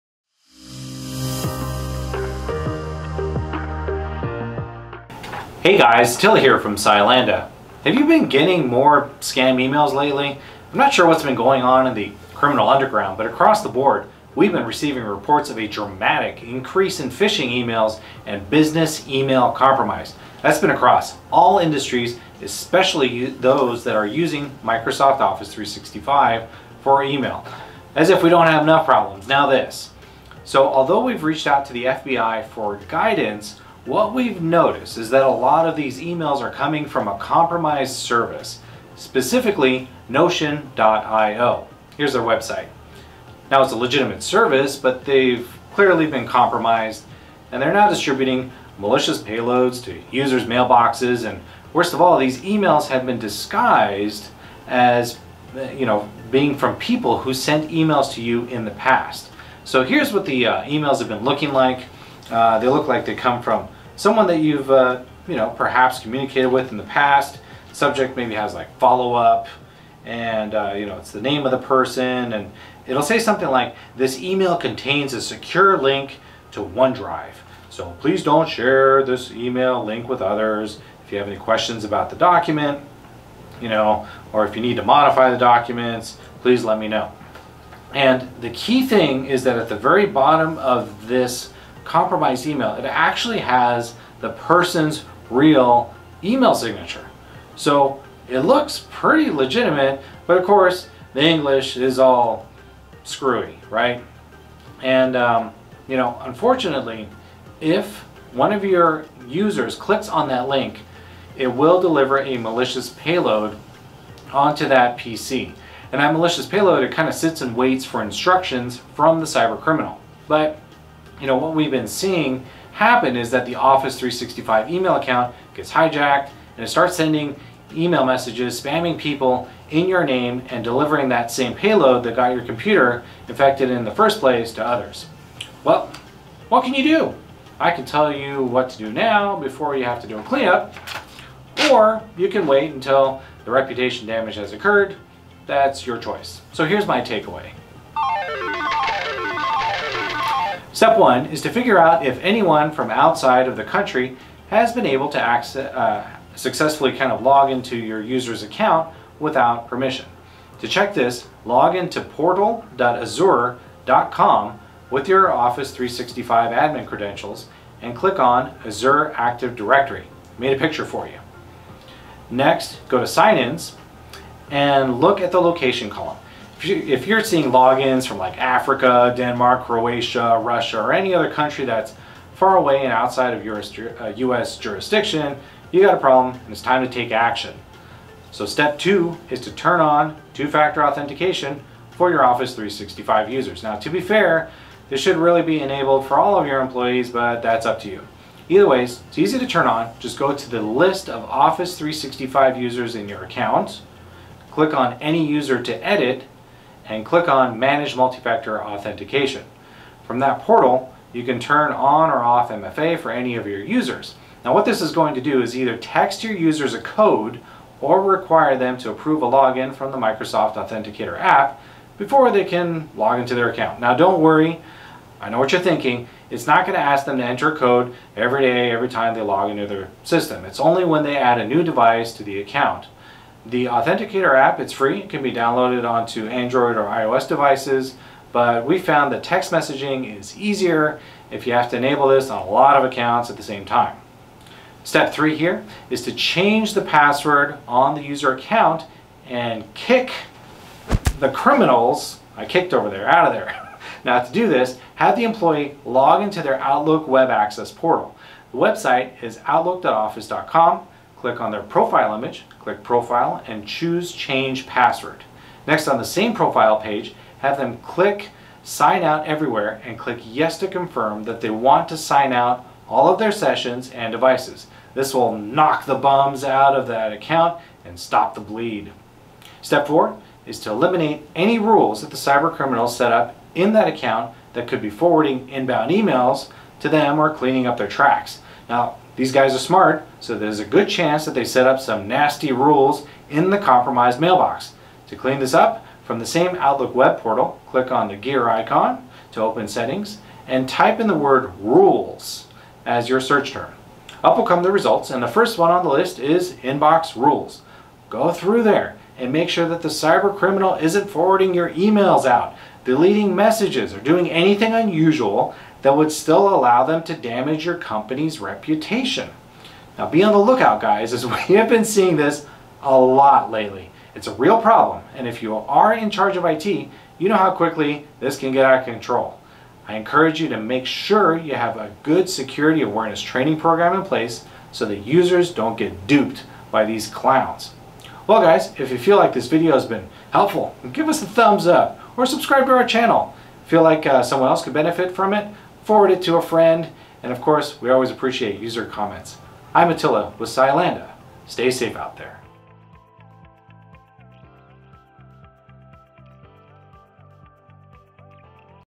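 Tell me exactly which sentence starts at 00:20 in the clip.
That's been across all industries, especially those that are using Microsoft Office 365 for email.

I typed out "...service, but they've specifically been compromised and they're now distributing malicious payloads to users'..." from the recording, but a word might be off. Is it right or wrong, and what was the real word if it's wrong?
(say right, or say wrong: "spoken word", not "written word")
wrong: "clearly", not "specifically".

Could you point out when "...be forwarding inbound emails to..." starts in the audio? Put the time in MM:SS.
04:44.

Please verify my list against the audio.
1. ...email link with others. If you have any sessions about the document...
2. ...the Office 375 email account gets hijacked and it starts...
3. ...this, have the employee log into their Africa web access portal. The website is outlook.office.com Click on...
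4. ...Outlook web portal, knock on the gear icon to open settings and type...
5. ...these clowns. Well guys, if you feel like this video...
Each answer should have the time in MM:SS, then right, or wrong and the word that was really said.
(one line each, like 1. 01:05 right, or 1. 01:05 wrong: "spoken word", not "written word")
1. 01:19 wrong: "questions", not "sessions"
2. 02:03 wrong: "365", not "375"
3. 04:14 wrong: "Outlook", not "Africa"
4. 04:56 wrong: "click", not "knock"
5. 05:36 right.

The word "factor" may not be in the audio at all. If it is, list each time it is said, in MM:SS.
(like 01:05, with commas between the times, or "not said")
03:10, 03:27.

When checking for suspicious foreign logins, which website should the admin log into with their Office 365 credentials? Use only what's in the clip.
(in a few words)
portal.azure.com.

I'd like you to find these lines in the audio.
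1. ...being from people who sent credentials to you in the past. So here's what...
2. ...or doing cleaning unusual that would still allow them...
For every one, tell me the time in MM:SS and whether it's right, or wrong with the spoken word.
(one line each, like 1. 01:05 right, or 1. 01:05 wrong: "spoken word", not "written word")
1. 00:56 wrong: "emails", not "credentials"
2. 05:13 wrong: "anything", not "cleaning".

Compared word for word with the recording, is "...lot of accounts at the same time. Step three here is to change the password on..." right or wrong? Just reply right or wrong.
right.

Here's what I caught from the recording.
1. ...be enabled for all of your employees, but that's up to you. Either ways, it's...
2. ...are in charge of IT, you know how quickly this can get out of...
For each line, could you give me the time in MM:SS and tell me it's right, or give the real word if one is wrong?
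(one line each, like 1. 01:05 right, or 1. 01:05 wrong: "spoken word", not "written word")
1. 03:15 right
2. 05:25 right.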